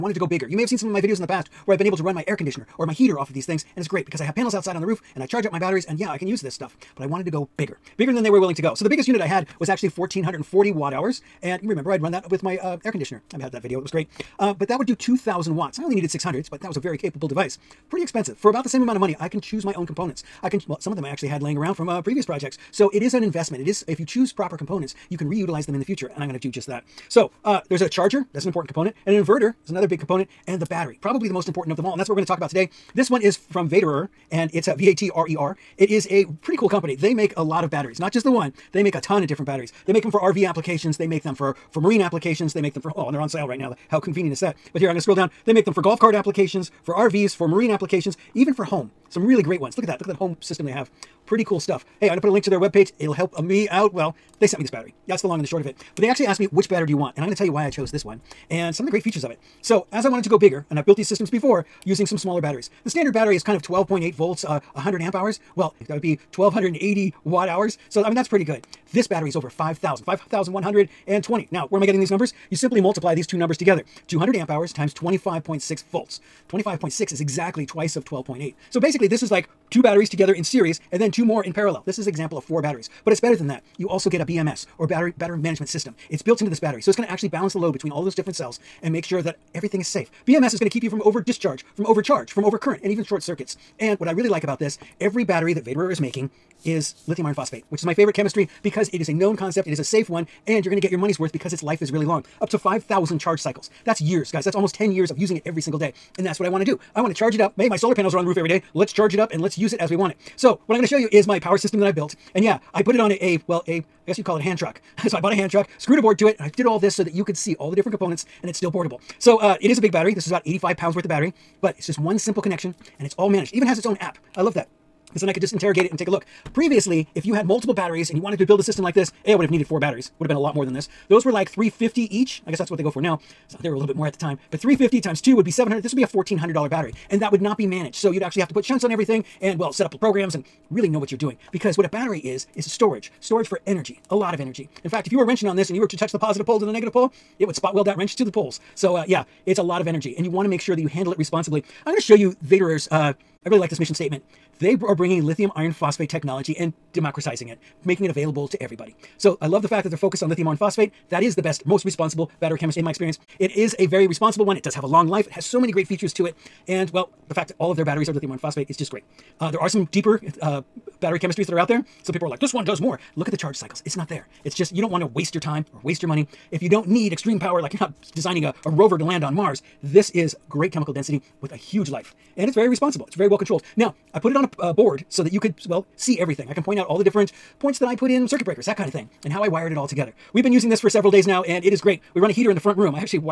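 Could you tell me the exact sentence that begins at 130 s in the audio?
Would have been a lot more than this.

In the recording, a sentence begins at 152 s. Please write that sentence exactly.
Uh, I really like this mission statement.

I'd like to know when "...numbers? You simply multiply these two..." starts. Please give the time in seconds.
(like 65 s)
72 s.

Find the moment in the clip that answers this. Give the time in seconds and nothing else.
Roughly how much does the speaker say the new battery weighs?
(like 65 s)
120 s.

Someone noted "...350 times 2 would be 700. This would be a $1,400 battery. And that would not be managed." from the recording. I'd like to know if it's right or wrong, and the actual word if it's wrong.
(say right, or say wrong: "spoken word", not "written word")
right.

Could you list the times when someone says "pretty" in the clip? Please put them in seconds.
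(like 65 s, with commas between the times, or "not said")
17 s, 36 s, 51 s, 68 s.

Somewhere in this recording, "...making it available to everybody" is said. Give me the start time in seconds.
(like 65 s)
157 s.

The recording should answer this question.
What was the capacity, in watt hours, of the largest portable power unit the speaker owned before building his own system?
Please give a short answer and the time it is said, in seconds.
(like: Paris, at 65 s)
1440 watt hours, at 9 s.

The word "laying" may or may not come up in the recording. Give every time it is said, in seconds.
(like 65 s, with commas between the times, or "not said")
21 s.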